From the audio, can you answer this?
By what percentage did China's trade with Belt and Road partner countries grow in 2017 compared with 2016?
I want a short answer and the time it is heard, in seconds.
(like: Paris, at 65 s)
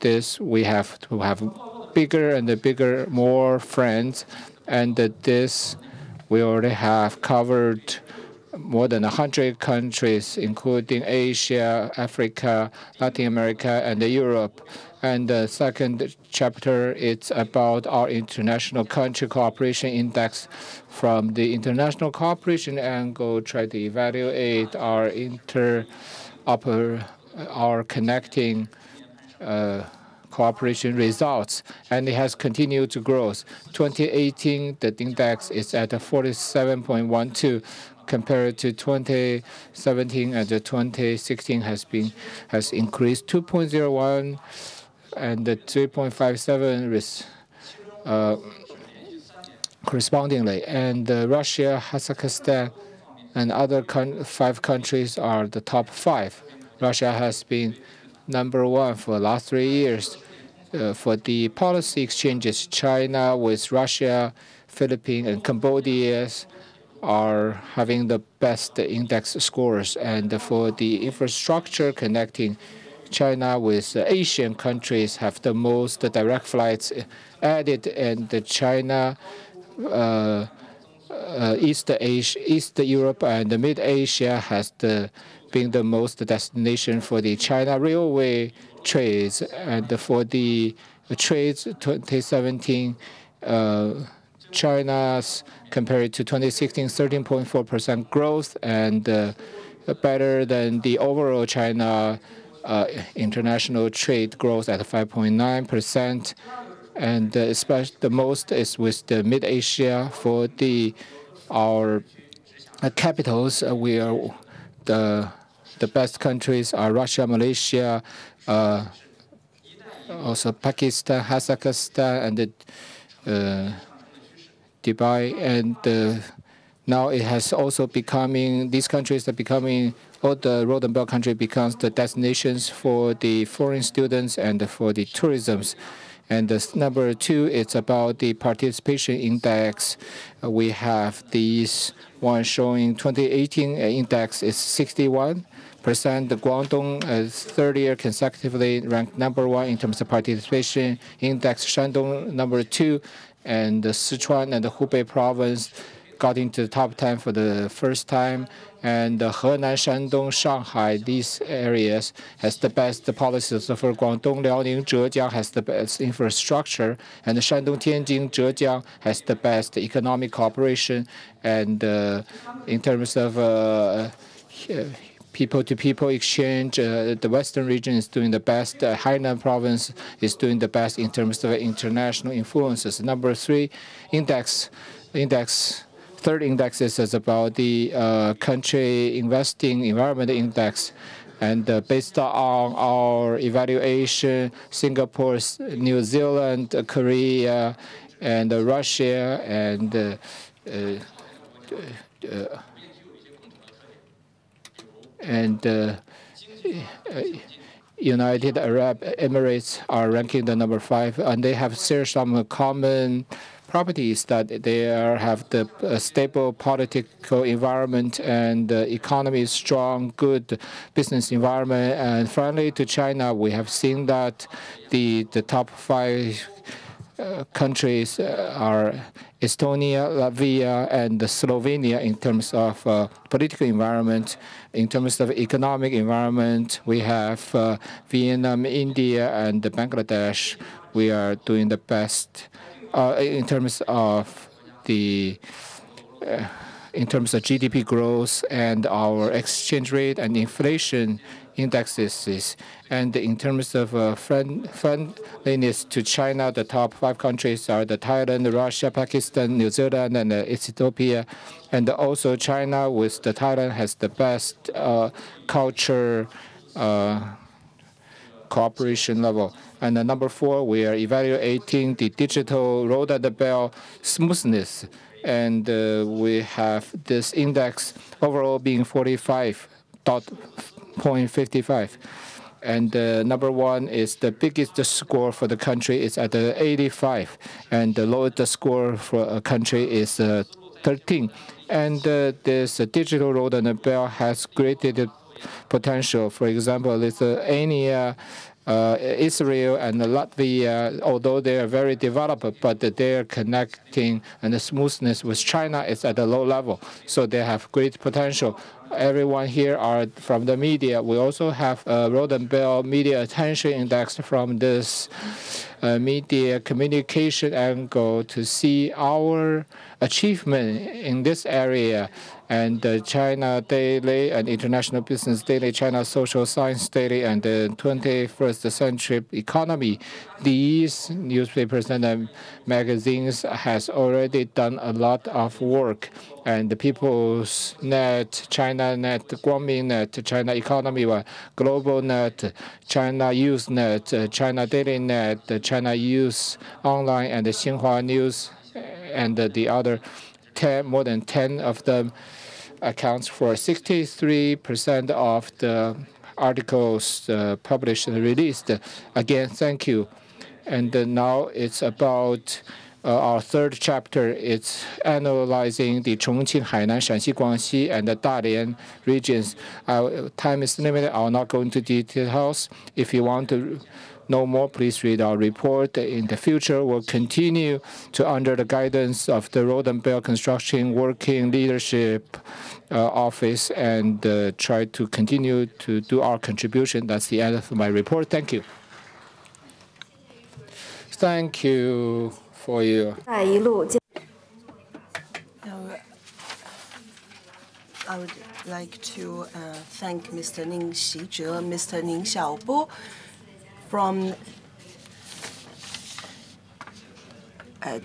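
13.4%, at 96 s.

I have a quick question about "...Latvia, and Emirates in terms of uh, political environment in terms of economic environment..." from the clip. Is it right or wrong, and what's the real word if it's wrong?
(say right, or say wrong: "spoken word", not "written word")
wrong: "Slovenia", not "Emirates".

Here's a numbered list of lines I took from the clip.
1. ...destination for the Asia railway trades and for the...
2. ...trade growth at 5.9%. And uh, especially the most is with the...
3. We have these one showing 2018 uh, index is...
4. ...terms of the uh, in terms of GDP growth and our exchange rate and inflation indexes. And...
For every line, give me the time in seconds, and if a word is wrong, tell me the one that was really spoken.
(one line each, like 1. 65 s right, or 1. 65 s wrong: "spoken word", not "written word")
1. 86 s wrong: "China", not "Asia"
2. 103 s right
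3. 140 s right
4. 243 s right.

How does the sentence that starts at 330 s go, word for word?
These newspapers and um, magazines has already done a lot of work.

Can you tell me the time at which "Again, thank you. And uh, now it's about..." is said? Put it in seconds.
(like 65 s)
359 s.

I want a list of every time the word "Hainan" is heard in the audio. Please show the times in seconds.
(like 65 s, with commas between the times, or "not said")
178 s, 366 s.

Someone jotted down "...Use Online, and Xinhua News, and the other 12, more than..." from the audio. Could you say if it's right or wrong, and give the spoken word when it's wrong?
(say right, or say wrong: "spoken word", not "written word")
wrong: "10", not "12".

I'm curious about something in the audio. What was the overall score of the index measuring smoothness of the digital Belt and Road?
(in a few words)
45.55.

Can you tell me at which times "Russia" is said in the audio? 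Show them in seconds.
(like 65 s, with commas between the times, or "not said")
51 s, 56 s, 63 s, 116 s, 198 s, 258 s.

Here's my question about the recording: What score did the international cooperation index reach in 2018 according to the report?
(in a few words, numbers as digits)
47.12.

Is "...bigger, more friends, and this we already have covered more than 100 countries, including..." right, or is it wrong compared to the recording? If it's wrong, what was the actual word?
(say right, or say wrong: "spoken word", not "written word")
right.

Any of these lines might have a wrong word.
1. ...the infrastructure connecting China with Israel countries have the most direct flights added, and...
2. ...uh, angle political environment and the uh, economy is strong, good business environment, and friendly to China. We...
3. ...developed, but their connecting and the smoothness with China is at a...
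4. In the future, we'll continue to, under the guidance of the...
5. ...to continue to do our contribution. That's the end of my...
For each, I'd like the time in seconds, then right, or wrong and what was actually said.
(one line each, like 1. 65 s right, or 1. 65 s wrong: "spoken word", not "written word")
1. 70 s wrong: "Asian", not "Israel"
2. 215 s wrong: "stable", not "angle"
3. 301 s right
4. 375 s right
5. 384 s right.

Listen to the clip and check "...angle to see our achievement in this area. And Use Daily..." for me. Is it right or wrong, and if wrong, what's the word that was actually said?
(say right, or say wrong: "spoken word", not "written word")
wrong: "China", not "Use".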